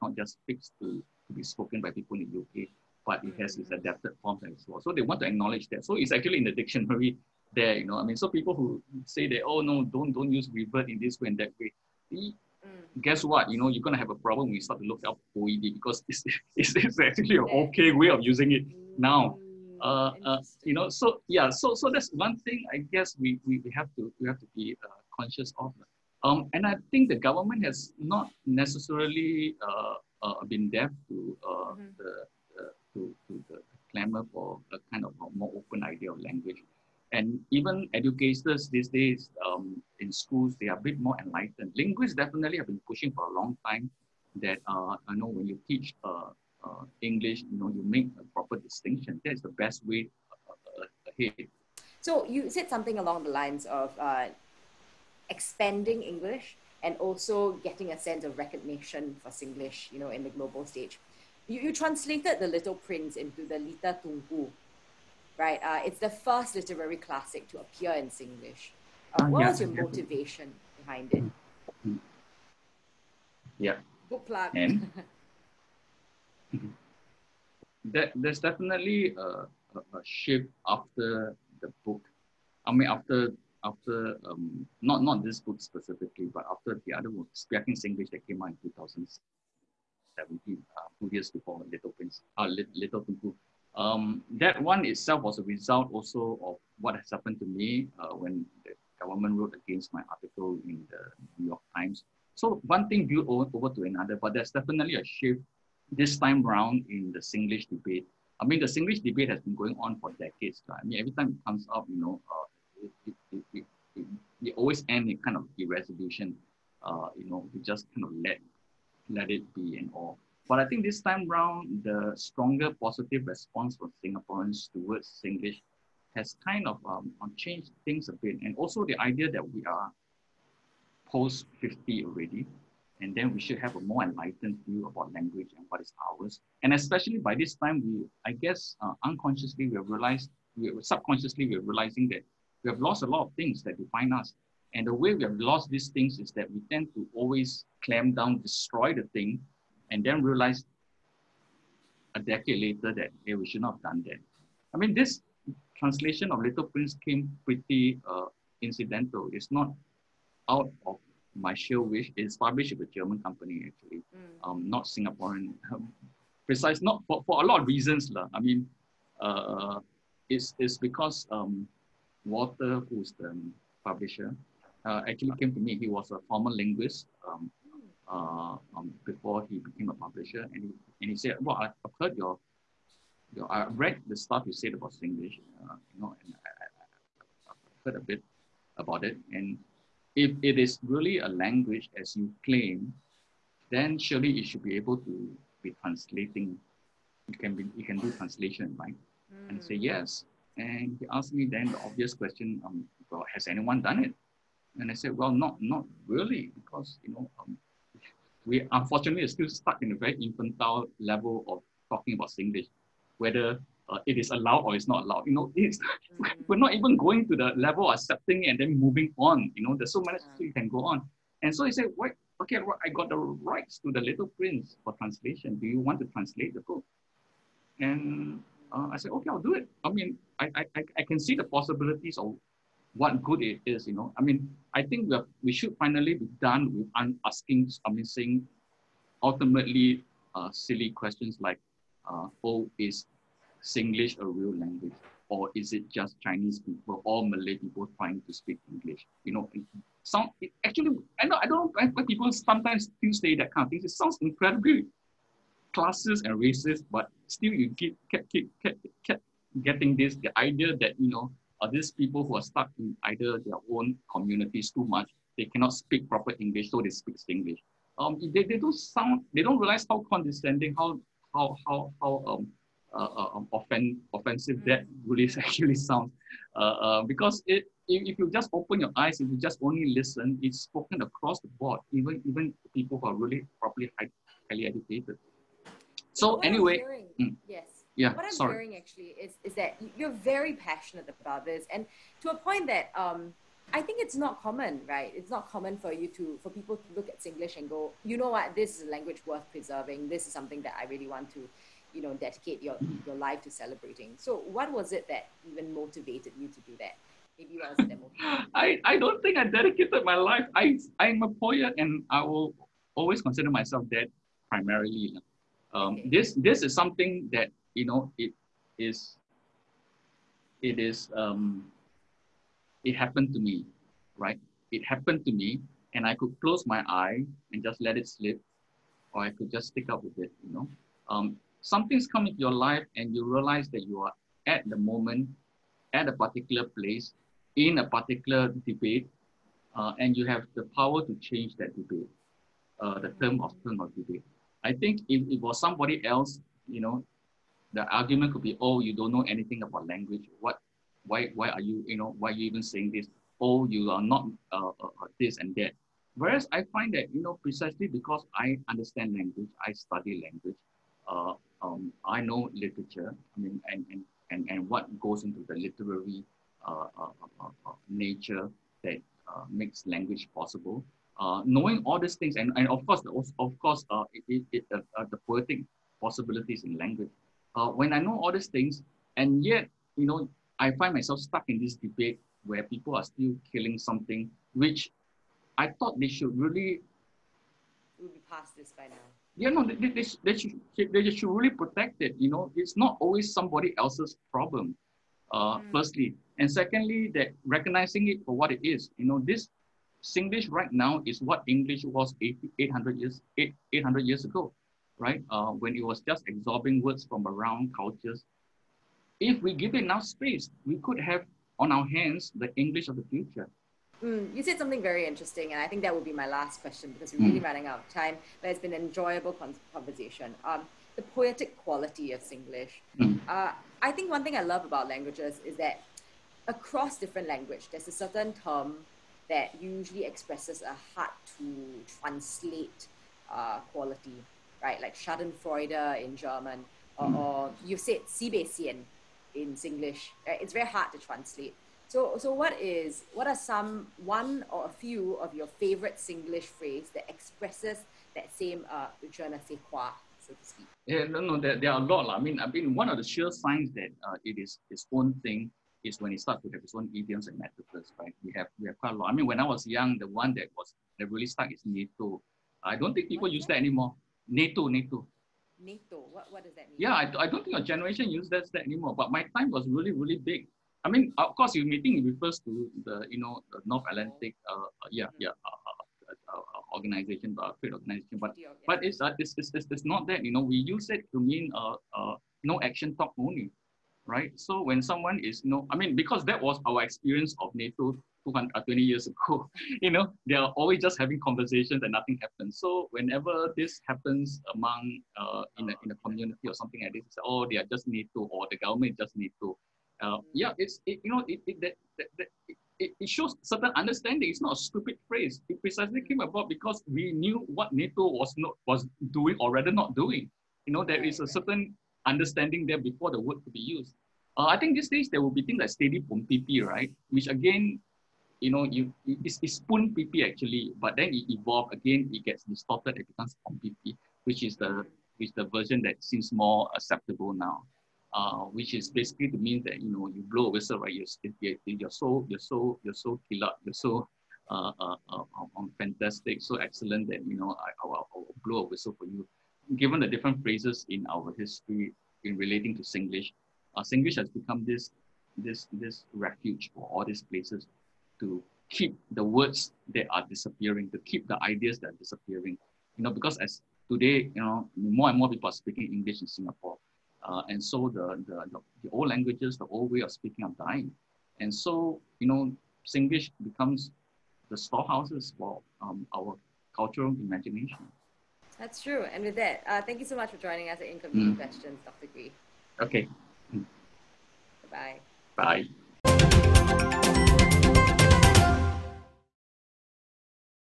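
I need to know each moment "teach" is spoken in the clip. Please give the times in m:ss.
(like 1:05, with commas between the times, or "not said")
0:45.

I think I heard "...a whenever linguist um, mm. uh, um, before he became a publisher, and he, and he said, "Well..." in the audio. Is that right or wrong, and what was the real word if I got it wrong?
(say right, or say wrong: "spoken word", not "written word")
wrong: "former", not "whenever".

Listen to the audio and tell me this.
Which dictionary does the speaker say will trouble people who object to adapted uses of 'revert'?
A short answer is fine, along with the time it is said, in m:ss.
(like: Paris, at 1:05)
OED, at 0:15.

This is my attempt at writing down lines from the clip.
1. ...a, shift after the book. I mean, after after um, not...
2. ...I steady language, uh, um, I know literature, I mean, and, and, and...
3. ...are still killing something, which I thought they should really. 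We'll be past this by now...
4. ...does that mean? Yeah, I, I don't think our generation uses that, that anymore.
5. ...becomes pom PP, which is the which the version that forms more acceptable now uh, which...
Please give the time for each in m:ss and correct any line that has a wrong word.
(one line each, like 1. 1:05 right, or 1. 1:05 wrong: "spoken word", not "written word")
1. 1:19 right
2. 5:59 wrong: "study", not "steady"
3. 6:22 right
4. 7:46 right
5. 8:43 wrong: "seems", not "forms".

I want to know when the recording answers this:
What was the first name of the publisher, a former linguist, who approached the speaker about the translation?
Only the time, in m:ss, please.
2:52.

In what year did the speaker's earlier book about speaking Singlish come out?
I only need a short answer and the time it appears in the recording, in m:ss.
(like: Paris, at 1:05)
2017, at 1:28.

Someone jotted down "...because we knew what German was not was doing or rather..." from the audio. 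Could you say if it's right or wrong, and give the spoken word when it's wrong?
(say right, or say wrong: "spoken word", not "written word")
wrong: "NATO", not "German".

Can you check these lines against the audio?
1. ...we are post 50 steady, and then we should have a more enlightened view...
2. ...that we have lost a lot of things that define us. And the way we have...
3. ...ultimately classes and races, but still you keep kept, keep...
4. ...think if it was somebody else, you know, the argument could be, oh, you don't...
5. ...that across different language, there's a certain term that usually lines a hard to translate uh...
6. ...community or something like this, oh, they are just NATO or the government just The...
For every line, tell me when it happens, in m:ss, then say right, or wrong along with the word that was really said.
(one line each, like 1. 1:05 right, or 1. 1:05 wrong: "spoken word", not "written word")
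1. 2:09 wrong: "already", not "steady"
2. 2:22 right
3. 4:14 wrong: "incredibly", not "ultimately"
4. 5:44 right
5. 7:05 wrong: "expresses", not "lines"
6. 8:16 wrong: "NATO", not "The".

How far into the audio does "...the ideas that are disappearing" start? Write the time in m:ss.
9:11.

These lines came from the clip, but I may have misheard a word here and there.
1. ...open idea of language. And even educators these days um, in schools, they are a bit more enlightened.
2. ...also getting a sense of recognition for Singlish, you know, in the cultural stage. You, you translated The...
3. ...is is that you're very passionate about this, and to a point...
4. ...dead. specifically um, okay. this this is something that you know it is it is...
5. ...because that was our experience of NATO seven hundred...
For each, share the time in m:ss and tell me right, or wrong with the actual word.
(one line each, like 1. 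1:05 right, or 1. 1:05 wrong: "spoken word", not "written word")
1. 0:35 right
2. 0:56 wrong: "global", not "cultural"
3. 4:49 right
4. 5:13 wrong: "primarily", not "specifically"
5. 8:05 wrong: "two", not "seven".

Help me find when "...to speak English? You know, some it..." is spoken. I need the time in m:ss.
4:08.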